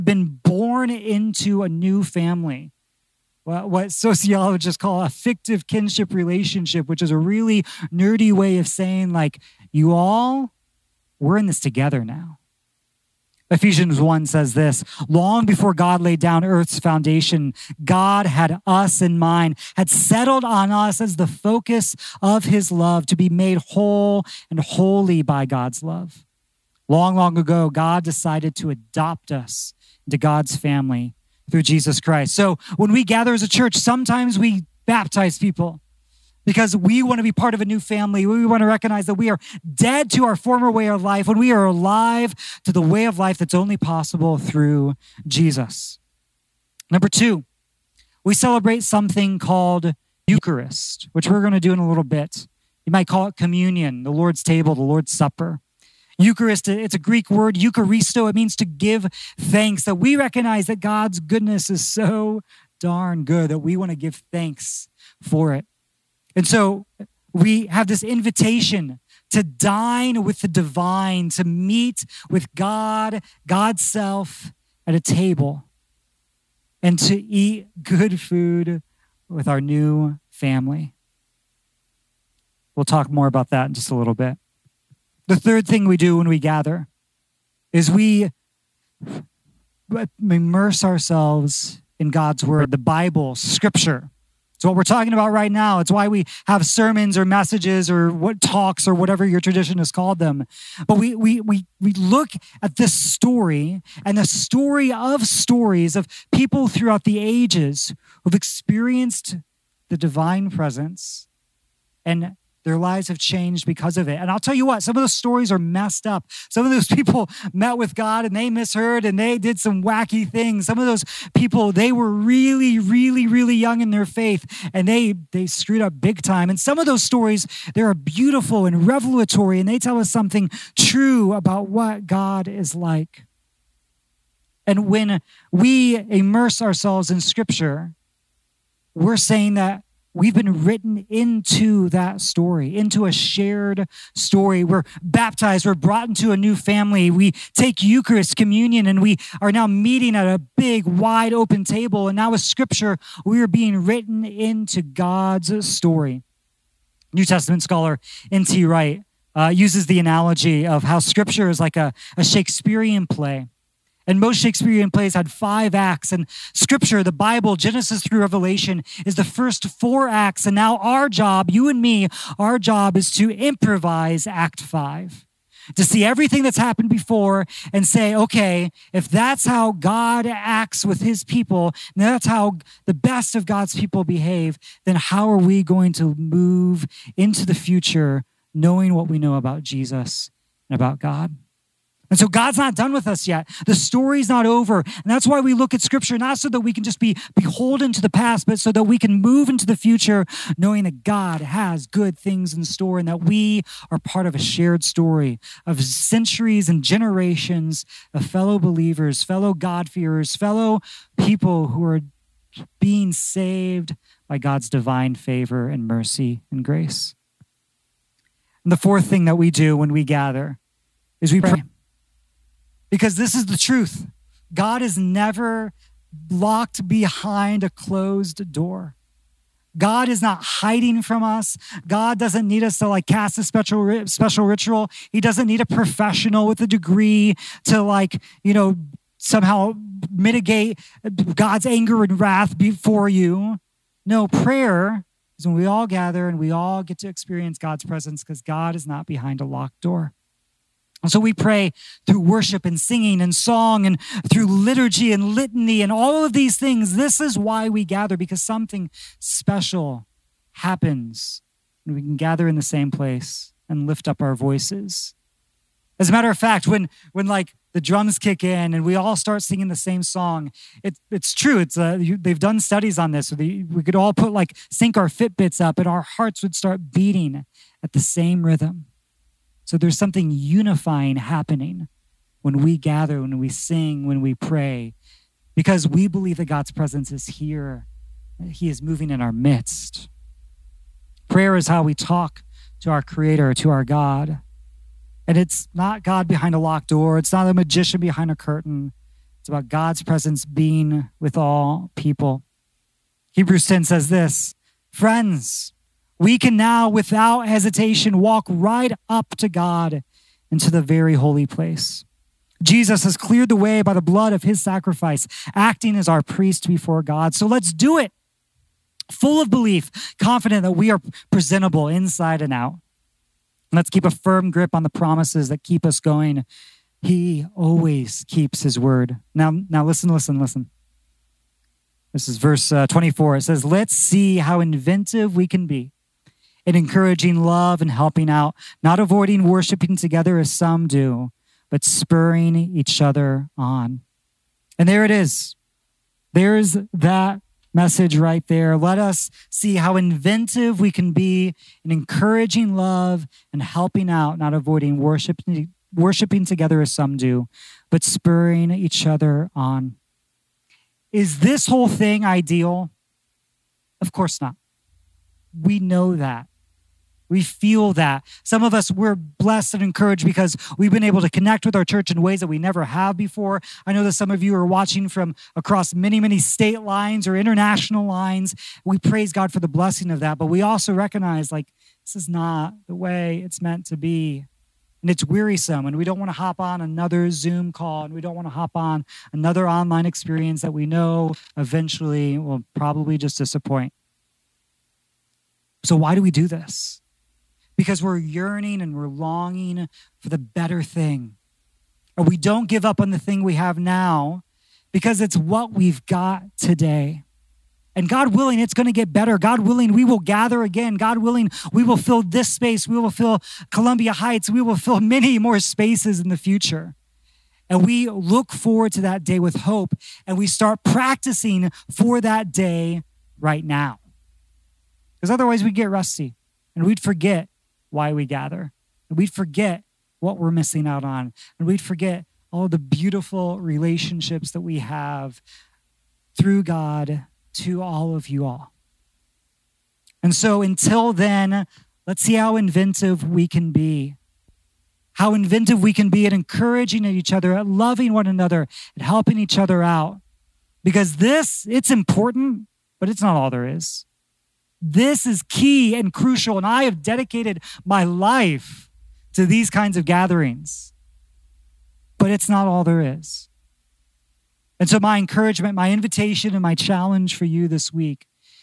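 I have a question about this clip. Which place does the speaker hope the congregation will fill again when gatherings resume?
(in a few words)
Columbia Heights.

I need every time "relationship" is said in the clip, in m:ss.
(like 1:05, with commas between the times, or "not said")
0:06, 7:13.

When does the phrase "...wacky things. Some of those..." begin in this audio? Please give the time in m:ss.
1:59.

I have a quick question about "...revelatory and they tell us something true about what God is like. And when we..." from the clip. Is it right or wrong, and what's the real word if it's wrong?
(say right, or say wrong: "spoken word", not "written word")
right.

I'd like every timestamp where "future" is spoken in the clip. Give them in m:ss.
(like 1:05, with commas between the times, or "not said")
3:07, 3:19, 6:56.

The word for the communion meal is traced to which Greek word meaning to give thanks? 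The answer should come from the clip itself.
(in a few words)
Eucharisto.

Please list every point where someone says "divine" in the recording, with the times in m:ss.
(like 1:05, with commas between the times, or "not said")
1:10, 1:49, 3:34.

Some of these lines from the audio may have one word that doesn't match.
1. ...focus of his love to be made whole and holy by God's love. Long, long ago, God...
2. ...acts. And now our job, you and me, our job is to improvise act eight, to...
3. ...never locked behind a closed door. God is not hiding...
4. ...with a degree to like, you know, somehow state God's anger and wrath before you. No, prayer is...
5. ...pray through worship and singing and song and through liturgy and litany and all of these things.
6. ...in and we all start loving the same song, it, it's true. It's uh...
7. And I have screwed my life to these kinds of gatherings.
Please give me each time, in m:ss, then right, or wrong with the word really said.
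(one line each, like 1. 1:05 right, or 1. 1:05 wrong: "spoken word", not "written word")
1. 0:21 right
2. 2:50 wrong: "five", not "eight"
3. 3:44 right
4. 3:56 wrong: "mitigate", not "state"
5. 4:11 right
6. 4:28 wrong: "singing", not "loving"
7. 7:36 wrong: "dedicated", not "screwed".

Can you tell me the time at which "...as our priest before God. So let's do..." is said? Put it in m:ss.
5:15.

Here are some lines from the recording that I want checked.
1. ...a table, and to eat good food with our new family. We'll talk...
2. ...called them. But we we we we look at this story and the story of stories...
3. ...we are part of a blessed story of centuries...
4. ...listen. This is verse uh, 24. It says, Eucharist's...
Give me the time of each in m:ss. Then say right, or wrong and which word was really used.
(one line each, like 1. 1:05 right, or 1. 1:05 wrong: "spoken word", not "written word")
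1. 1:14 right
2. 1:39 right
3. 3:23 wrong: "shared", not "blessed"
4. 5:30 wrong: "Let", not "Eucharist".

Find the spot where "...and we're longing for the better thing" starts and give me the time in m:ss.
6:38.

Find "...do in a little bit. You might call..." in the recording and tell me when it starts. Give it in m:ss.
0:51.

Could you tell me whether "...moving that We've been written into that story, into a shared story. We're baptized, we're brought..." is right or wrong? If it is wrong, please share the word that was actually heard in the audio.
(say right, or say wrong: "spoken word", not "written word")
wrong: "saying", not "moving".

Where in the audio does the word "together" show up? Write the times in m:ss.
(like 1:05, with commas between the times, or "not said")
0:11, 5:39, 5:56.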